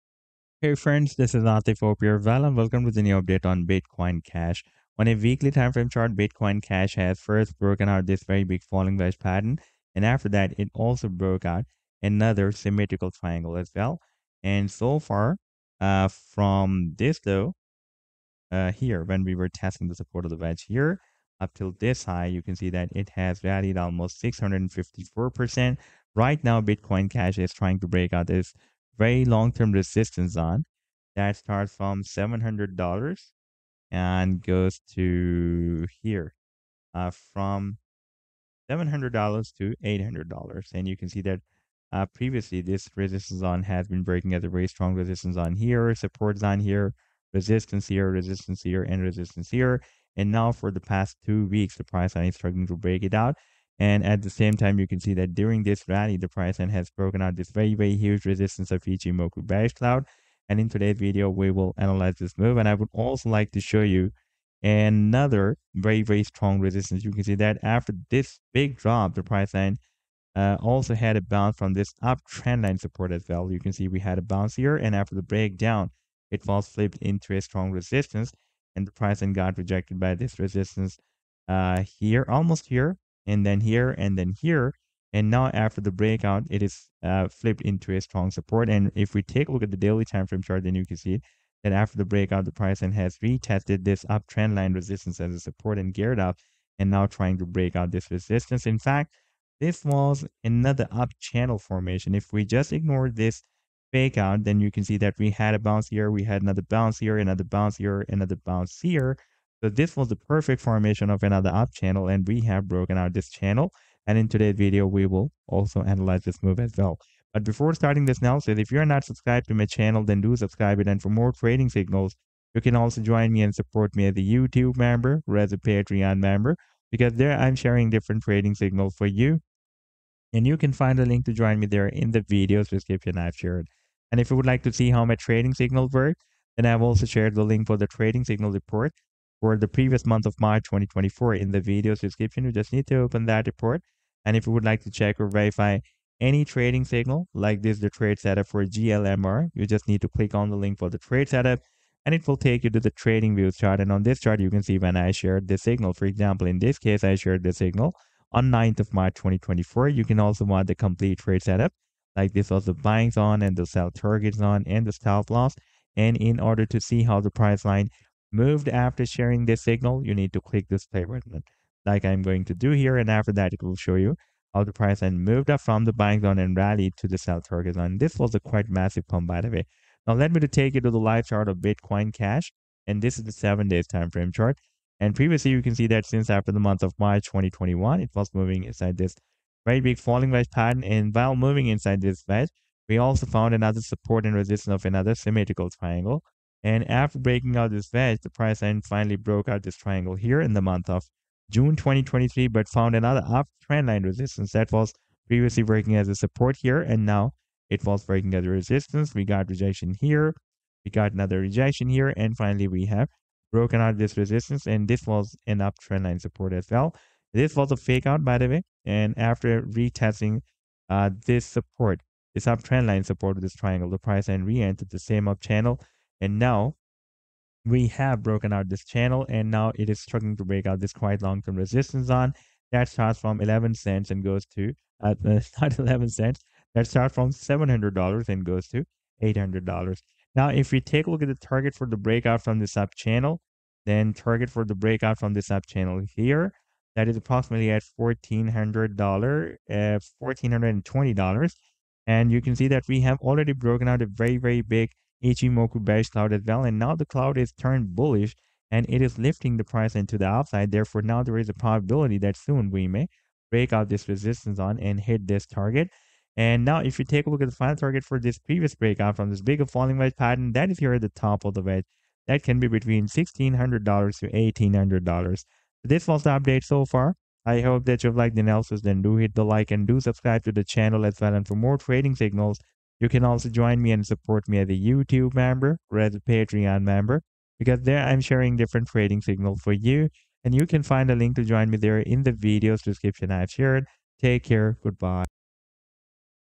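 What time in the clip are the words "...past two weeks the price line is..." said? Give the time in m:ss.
0:50.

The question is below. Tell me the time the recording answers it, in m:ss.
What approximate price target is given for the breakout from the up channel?
4:10.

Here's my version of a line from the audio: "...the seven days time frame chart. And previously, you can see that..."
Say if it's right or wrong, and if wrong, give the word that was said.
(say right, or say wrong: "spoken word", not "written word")
right.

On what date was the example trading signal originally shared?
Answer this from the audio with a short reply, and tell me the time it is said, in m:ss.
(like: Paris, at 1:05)
9 March 2024, at 2:38.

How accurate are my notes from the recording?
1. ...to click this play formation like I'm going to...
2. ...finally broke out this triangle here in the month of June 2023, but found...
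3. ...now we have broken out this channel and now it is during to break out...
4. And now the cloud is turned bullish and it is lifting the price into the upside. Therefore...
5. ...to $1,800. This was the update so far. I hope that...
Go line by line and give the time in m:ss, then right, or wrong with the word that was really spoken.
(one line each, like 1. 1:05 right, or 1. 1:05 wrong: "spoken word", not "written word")
1. 2:50 wrong: "button", not "formation"
2. 3:18 right
3. 3:46 wrong: "struggling", not "during"
4. 4:16 right
5. 4:34 right.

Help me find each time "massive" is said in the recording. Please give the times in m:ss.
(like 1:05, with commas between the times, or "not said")
2:58.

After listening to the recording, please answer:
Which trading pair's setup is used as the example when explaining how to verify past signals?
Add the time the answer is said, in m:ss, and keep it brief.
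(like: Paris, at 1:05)
GLMR, at 2:28.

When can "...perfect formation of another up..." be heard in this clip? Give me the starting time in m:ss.
1:50.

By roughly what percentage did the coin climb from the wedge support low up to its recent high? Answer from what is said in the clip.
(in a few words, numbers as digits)
654%.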